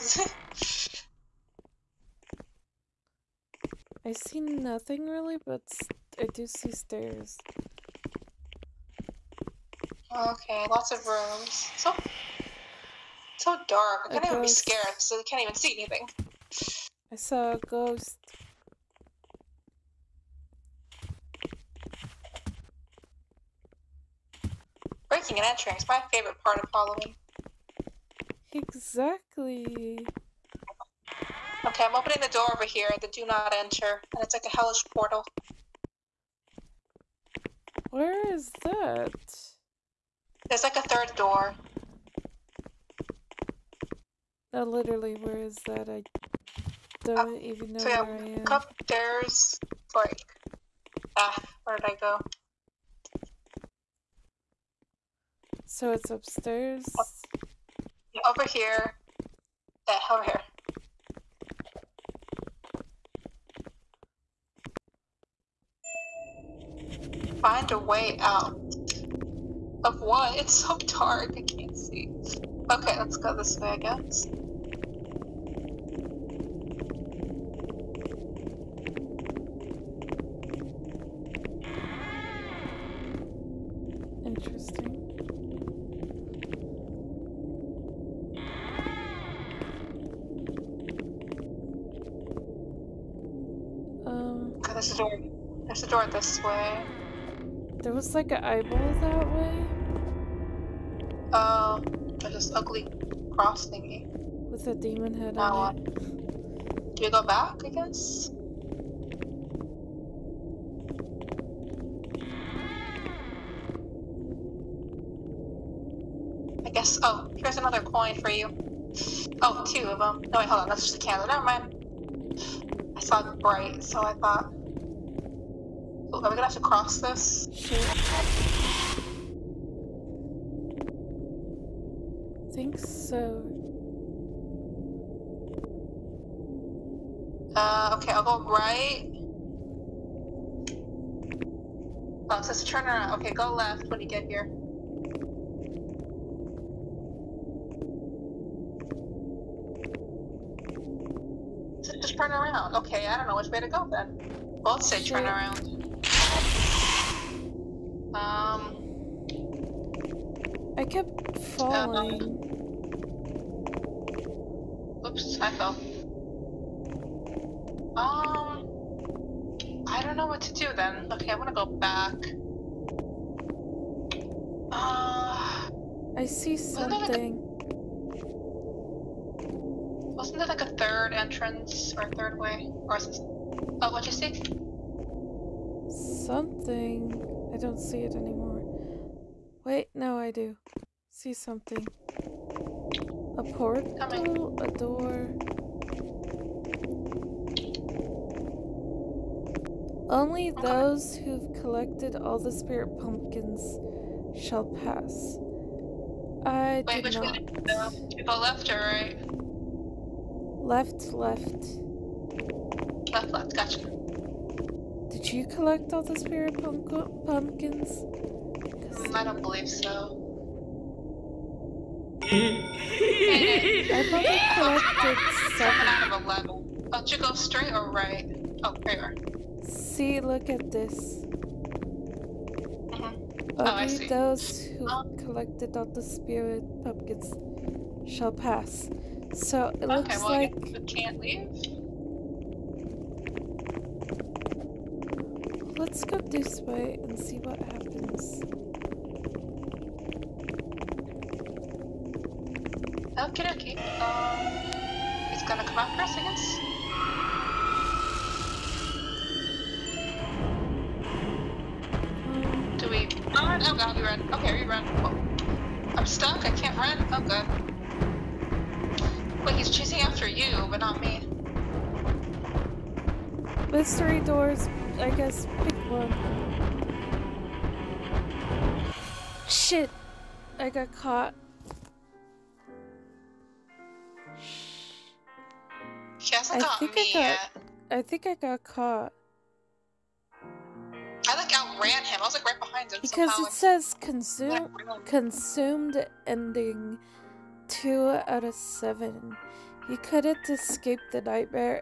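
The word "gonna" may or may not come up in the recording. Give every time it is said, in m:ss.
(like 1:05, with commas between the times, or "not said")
2:06, 2:51, 4:15.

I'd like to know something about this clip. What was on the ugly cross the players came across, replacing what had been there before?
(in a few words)
A demon head.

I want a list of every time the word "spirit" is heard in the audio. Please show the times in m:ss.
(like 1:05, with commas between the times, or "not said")
3:22, 3:36, 3:56.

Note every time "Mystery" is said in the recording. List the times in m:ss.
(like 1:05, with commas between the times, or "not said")
4:33.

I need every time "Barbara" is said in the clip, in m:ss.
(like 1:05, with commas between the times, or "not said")
not said.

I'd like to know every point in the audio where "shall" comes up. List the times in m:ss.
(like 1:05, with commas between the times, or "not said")
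3:24, 3:58.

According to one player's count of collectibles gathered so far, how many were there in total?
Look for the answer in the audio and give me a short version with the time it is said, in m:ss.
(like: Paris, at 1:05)
11, at 3:46.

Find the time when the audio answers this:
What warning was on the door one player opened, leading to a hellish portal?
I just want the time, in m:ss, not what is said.
0:33.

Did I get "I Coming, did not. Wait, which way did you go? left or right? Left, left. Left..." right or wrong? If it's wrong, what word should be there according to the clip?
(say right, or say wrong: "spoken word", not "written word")
wrong: "Wait", not "Coming".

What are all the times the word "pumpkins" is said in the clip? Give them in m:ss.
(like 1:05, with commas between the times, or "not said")
3:22, 3:36, 3:56.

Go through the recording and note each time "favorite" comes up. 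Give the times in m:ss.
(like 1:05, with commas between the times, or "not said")
0:26.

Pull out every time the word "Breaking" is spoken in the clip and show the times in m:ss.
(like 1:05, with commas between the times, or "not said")
0:25.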